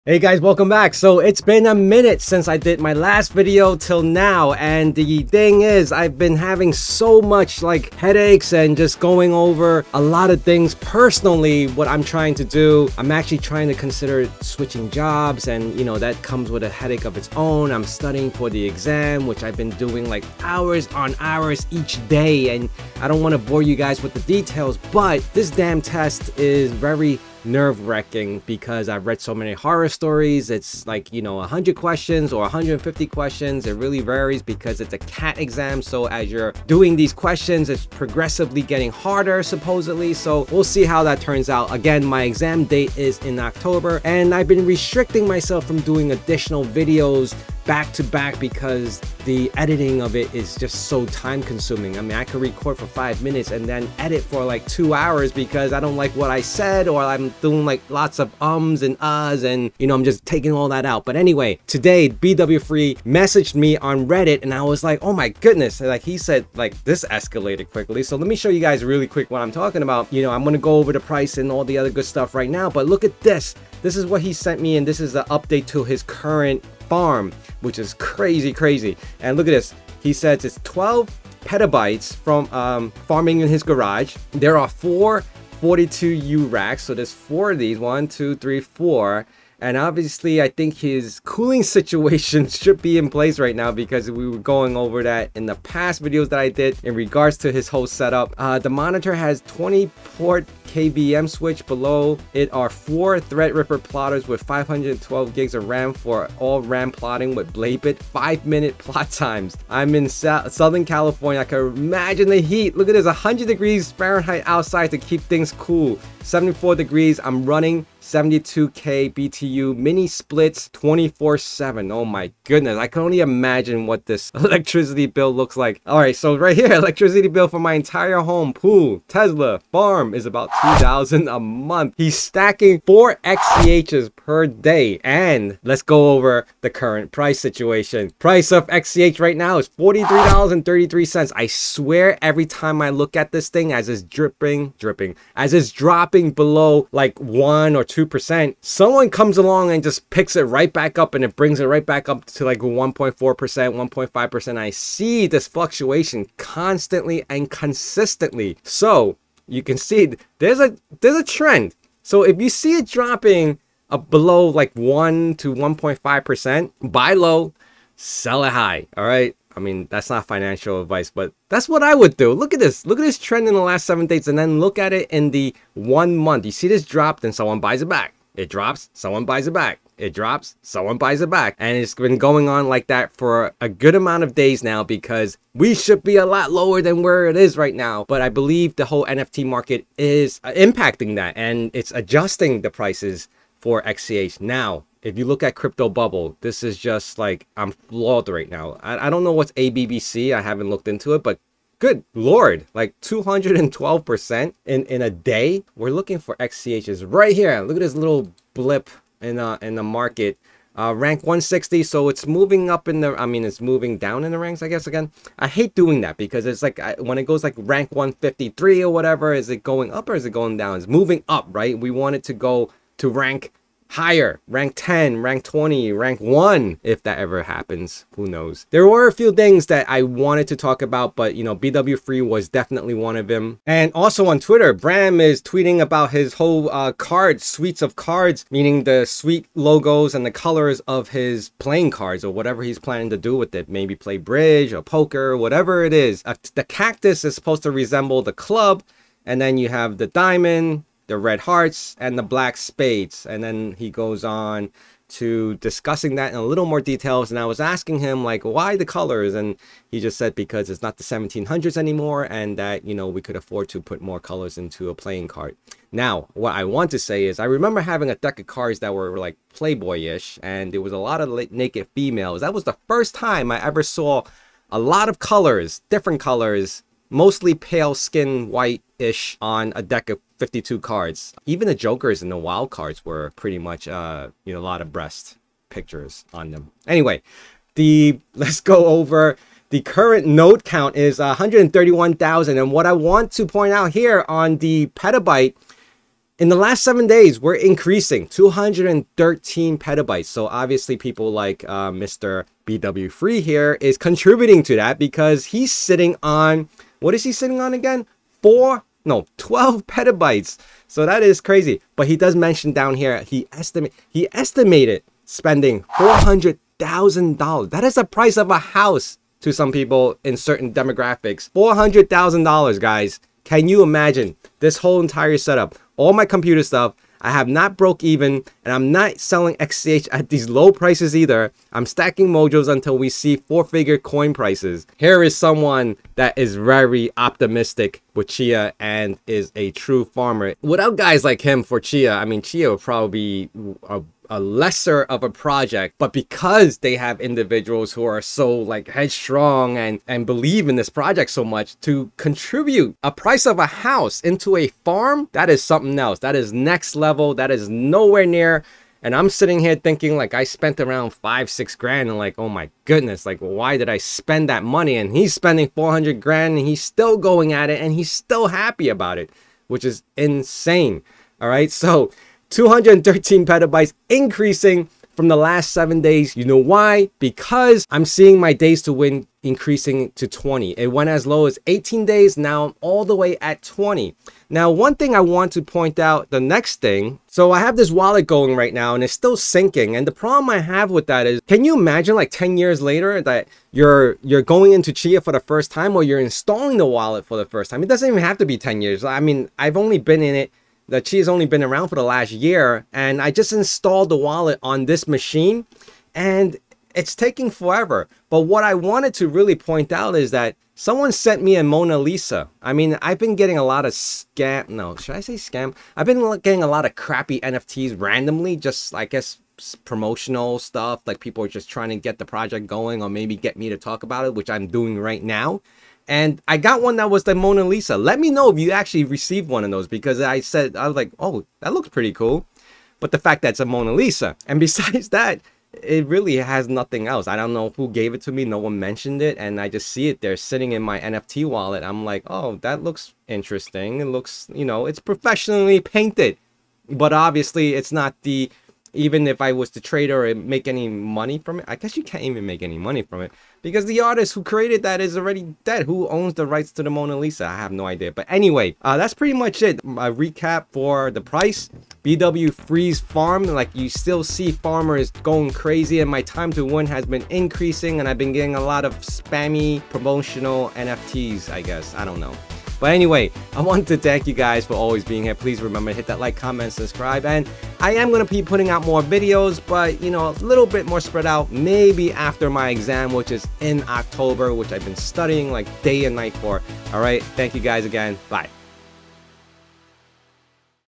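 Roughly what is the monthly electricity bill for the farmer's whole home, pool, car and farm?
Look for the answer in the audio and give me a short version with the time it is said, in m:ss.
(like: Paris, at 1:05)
$2000, at 2:10.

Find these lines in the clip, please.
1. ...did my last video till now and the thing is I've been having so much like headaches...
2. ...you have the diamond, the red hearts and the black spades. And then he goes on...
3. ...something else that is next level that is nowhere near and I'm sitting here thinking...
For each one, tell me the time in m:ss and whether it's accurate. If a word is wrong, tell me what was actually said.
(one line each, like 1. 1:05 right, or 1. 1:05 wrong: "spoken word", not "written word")
1. 0:02 right
2. 4:09 right
3. 5:55 right.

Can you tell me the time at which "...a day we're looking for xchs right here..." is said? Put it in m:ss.
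3:25.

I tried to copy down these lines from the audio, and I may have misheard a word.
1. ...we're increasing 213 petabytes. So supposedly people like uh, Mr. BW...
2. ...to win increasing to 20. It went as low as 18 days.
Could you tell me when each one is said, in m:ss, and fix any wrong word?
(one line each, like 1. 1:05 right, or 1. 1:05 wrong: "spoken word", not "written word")
1. 4:57 wrong: "obviously", not "supposedly"
2. 6:18 right.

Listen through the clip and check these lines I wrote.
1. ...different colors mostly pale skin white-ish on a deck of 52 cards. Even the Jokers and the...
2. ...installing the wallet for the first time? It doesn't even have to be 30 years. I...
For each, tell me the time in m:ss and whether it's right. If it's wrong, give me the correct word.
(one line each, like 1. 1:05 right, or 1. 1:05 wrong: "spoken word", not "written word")
1. 4:35 right
2. 6:36 wrong: "10", not "30".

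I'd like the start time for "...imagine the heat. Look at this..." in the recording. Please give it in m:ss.
1:51.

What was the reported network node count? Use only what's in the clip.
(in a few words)
131,000.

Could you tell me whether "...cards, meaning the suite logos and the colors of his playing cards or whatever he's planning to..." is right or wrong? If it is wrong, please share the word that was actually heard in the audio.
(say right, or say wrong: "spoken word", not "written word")
right.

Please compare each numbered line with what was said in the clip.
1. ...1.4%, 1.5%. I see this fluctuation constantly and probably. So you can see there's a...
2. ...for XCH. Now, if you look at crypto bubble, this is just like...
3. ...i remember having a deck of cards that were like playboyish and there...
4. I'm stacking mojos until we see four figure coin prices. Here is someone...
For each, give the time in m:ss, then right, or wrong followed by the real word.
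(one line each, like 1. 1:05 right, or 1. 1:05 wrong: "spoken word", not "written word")
1. 2:32 wrong: "consistently", not "probably"
2. 3:13 right
3. 4:27 right
4. 5:31 right.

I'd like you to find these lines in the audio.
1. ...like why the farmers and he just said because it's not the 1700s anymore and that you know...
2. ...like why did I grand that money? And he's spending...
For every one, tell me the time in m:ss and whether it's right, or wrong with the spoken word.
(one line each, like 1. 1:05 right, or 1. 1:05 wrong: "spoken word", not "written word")
1. 4:18 wrong: "colors", not "farmers"
2. 6:03 wrong: "spend", not "grand".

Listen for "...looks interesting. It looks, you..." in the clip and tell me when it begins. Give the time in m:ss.
7:22.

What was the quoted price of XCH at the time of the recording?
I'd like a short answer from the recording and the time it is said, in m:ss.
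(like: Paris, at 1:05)
$43.33, at 2:19.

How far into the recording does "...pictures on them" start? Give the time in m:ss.
4:45.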